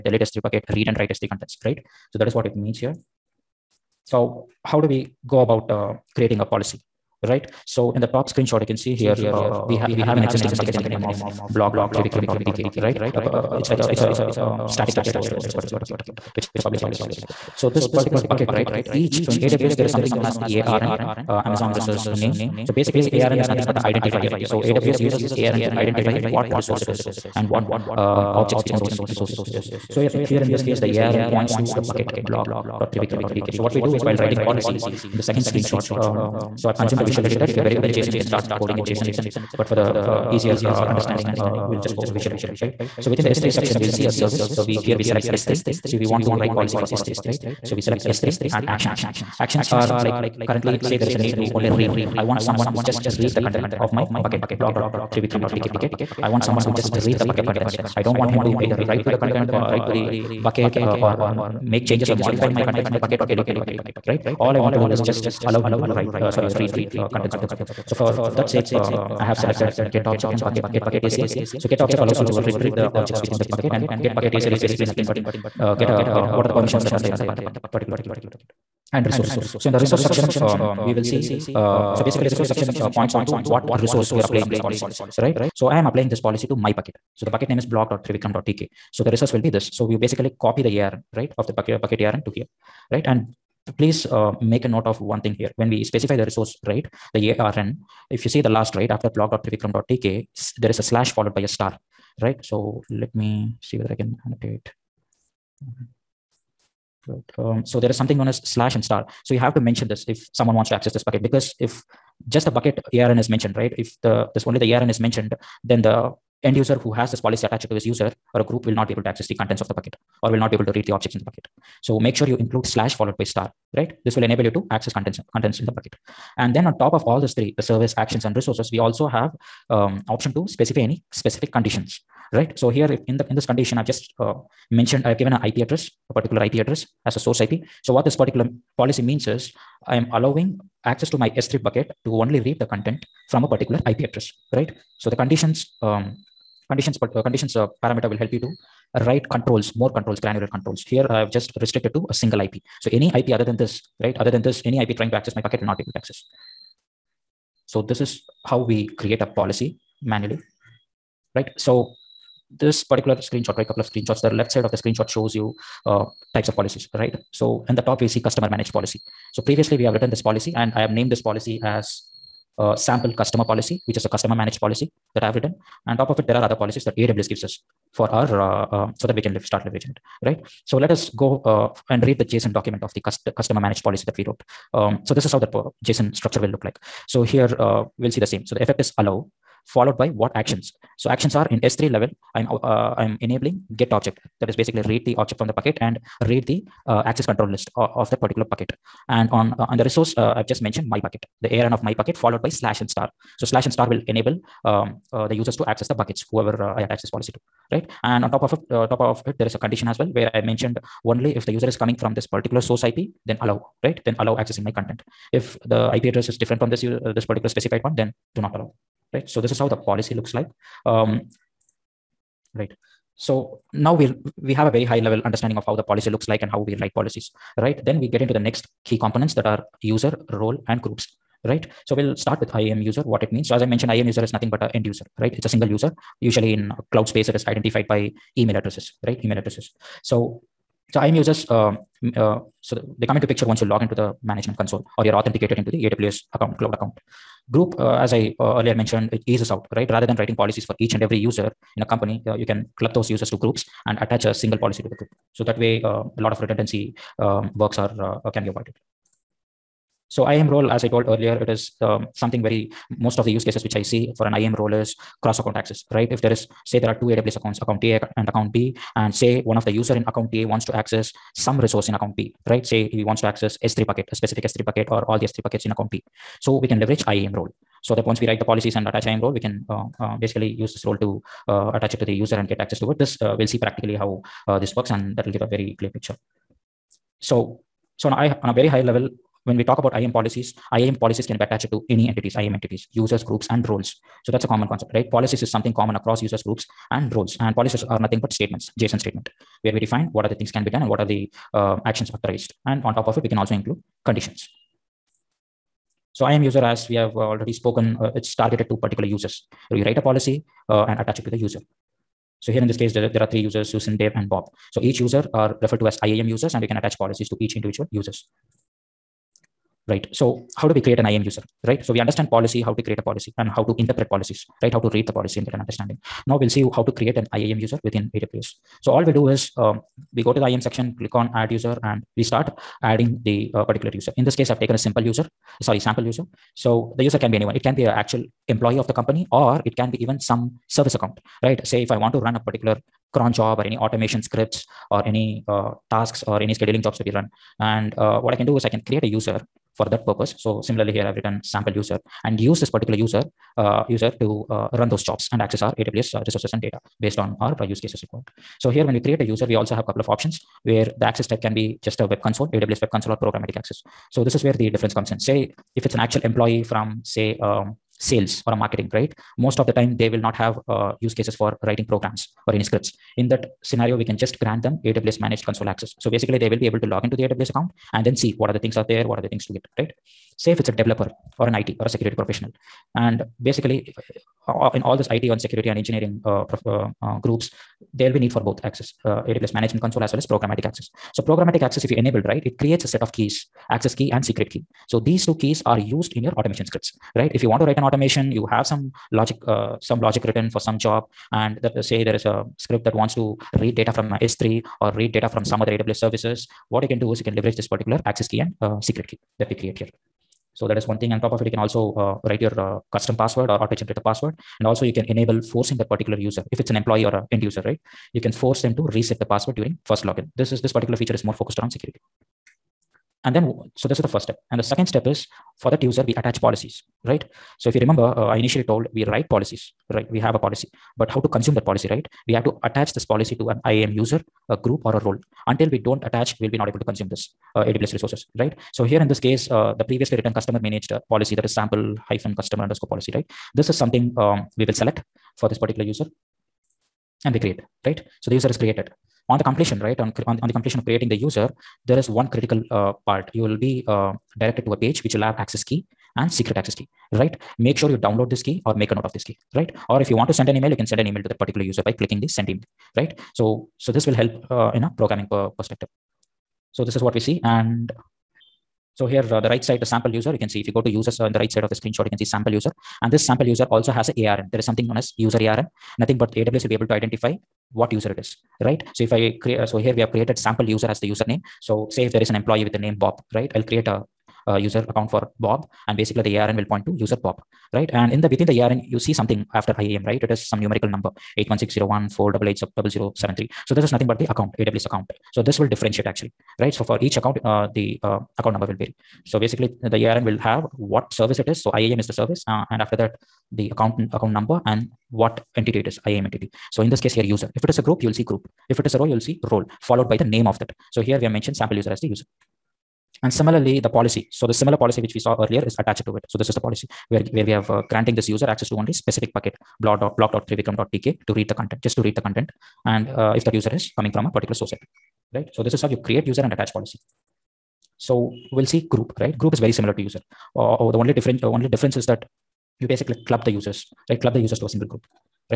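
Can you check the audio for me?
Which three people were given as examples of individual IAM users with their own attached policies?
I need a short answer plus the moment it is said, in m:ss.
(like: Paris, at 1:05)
Susan, Dave, and Bob, at 5:13.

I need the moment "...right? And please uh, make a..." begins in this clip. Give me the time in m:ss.
1:32.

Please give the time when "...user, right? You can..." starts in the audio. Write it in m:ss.
6:57.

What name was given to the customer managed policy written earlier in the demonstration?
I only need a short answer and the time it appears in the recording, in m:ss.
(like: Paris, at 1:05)
sample customer policy, at 2:52.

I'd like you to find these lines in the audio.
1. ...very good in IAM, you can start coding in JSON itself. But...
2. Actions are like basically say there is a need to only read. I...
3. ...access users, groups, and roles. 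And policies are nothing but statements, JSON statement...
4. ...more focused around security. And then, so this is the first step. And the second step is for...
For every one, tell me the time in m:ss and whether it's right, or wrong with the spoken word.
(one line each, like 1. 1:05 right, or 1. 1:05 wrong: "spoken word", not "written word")
1. 0:37 wrong: "JSON", not "IAM"
2. 0:49 wrong: "currently", not "basically"
3. 4:55 wrong: "across", not "access"
4. 7:01 right.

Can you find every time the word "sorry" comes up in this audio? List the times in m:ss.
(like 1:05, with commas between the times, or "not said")
1:06, 5:35.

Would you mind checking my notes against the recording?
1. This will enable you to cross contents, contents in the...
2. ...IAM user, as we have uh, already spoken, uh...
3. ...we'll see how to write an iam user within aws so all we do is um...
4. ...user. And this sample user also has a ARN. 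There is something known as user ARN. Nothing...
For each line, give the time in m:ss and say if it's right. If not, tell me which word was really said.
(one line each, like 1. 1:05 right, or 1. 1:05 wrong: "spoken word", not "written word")
1. 2:04 wrong: "access", not "cross"
2. 5:06 right
3. 5:26 wrong: "create", not "write"
4. 7:52 right.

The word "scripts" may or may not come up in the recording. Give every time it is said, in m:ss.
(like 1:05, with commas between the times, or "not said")
5:44, 6:12, 6:36, 6:42.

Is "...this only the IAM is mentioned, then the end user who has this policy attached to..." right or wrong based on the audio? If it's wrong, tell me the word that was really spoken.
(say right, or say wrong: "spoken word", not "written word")
wrong: "ARN", not "IAM".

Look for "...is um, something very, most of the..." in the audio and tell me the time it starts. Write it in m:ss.
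4:21.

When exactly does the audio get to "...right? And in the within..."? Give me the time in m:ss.
8:07.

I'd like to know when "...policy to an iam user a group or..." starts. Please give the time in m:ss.
7:13.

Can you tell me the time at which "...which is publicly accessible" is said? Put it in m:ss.
0:16.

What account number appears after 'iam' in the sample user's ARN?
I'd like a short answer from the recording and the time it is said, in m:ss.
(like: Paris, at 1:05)
8160148800073, at 8:11.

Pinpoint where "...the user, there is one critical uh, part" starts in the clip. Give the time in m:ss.
7:31.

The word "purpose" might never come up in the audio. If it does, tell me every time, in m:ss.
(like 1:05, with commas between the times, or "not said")
5:50.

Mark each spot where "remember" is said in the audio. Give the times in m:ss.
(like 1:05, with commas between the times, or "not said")
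7:07.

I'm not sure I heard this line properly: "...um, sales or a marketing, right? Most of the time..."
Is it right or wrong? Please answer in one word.
right.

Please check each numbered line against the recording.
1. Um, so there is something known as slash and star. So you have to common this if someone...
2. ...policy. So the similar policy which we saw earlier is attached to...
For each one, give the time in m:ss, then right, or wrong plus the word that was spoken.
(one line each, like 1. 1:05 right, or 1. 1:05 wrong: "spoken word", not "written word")
1. 1:47 wrong: "mention", not "common"
2. 8:33 right.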